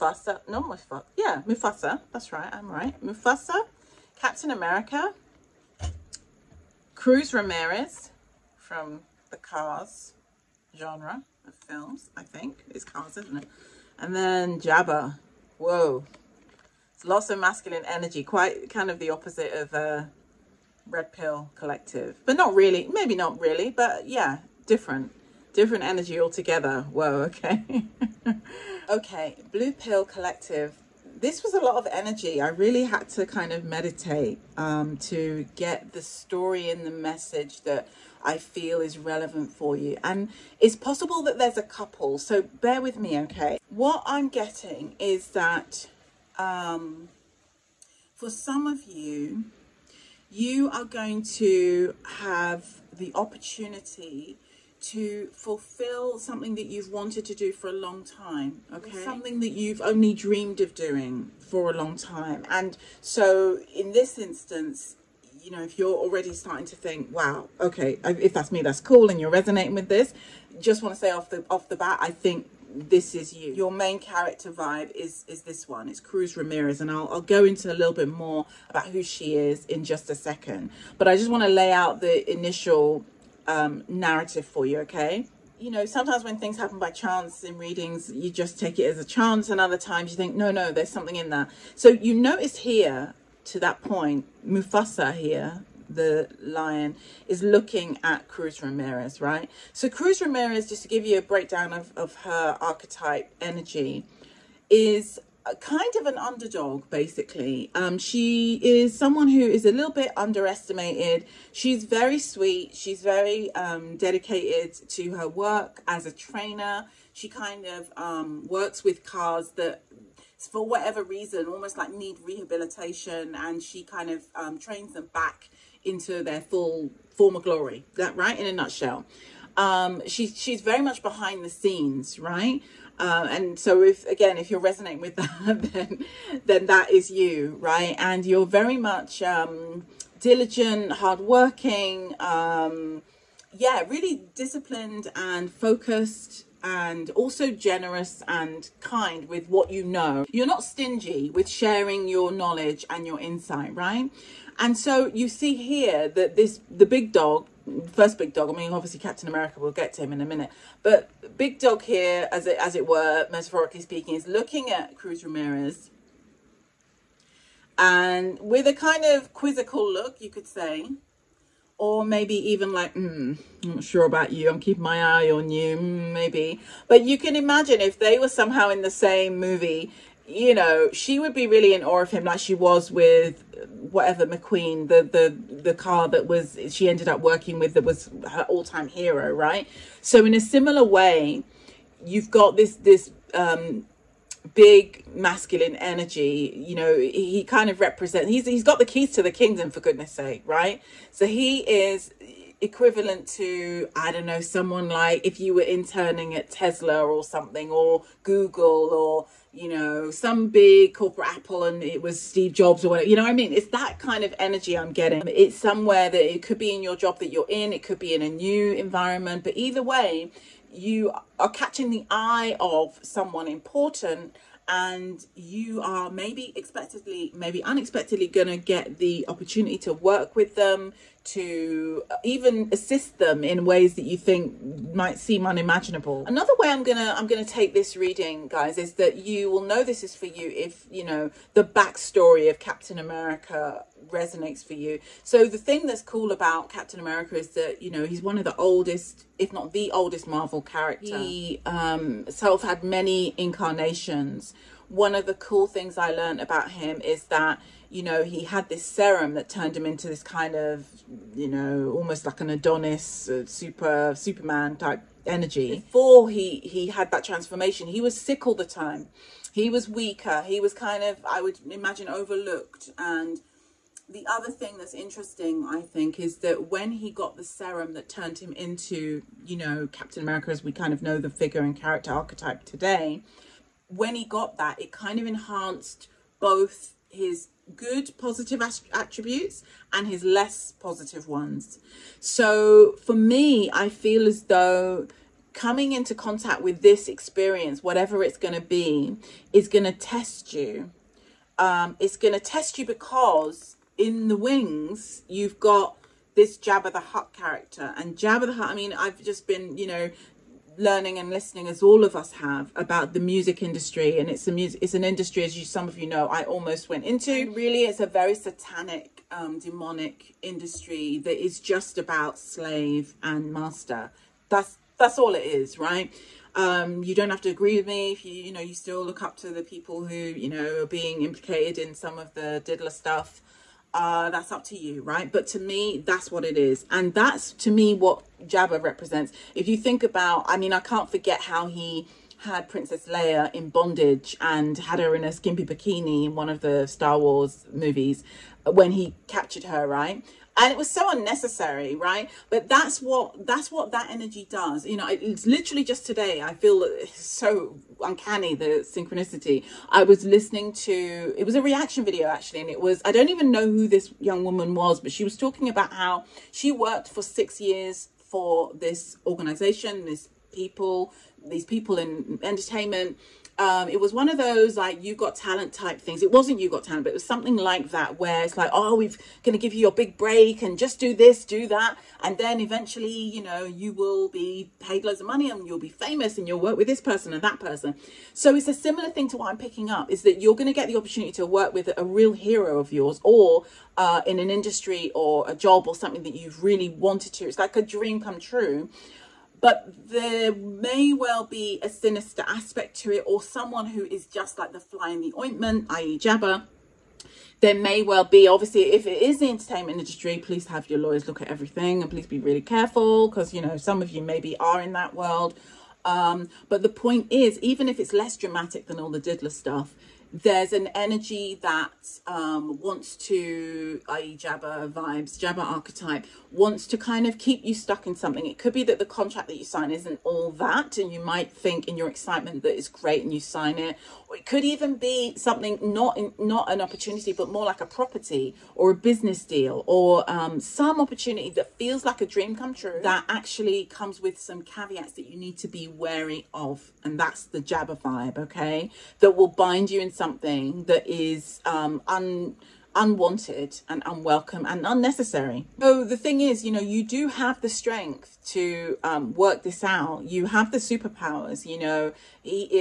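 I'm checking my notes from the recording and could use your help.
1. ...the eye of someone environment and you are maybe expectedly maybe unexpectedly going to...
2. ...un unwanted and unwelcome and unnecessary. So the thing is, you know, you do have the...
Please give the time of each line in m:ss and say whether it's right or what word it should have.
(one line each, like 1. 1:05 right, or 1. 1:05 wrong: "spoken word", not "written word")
1. 3:41 wrong: "important", not "environment"
2. 7:32 right.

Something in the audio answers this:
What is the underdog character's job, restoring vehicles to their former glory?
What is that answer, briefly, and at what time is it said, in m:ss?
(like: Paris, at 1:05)
Trainer, at 1:56.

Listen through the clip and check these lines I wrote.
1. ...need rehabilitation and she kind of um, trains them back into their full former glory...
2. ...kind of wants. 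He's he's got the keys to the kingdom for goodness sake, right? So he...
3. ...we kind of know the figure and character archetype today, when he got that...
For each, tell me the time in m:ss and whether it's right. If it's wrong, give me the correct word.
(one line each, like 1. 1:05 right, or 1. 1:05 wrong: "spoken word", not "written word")
1. 2:01 right
2. 3:17 wrong: "represents", not "wants"
3. 4:40 right.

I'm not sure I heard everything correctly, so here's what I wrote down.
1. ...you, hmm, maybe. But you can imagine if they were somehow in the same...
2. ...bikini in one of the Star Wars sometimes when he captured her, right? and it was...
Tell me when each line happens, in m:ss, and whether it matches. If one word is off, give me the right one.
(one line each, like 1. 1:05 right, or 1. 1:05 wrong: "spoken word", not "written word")
1. 2:55 right
2. 5:45 wrong: "movies", not "sometimes".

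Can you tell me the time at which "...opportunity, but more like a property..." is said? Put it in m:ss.
7:16.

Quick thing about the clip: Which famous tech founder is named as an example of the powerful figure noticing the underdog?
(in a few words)
Steve Jobs.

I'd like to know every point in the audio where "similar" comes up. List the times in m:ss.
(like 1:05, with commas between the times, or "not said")
3:10, 6:28.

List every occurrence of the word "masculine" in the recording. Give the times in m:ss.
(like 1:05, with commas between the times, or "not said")
0:17, 3:15.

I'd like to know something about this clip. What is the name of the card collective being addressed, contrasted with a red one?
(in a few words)
Blue Pill Collective.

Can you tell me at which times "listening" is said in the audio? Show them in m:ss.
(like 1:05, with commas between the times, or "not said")
5:11, 6:00.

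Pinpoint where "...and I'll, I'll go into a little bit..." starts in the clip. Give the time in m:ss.
1:16.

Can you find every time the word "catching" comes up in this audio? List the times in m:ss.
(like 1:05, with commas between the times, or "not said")
3:41.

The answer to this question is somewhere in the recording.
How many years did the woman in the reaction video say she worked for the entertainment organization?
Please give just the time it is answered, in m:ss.
6:07.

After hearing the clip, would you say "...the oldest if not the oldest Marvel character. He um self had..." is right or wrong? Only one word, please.
right.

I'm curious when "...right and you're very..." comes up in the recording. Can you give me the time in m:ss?
2:17.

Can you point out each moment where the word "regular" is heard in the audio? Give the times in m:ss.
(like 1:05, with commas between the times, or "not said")
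not said.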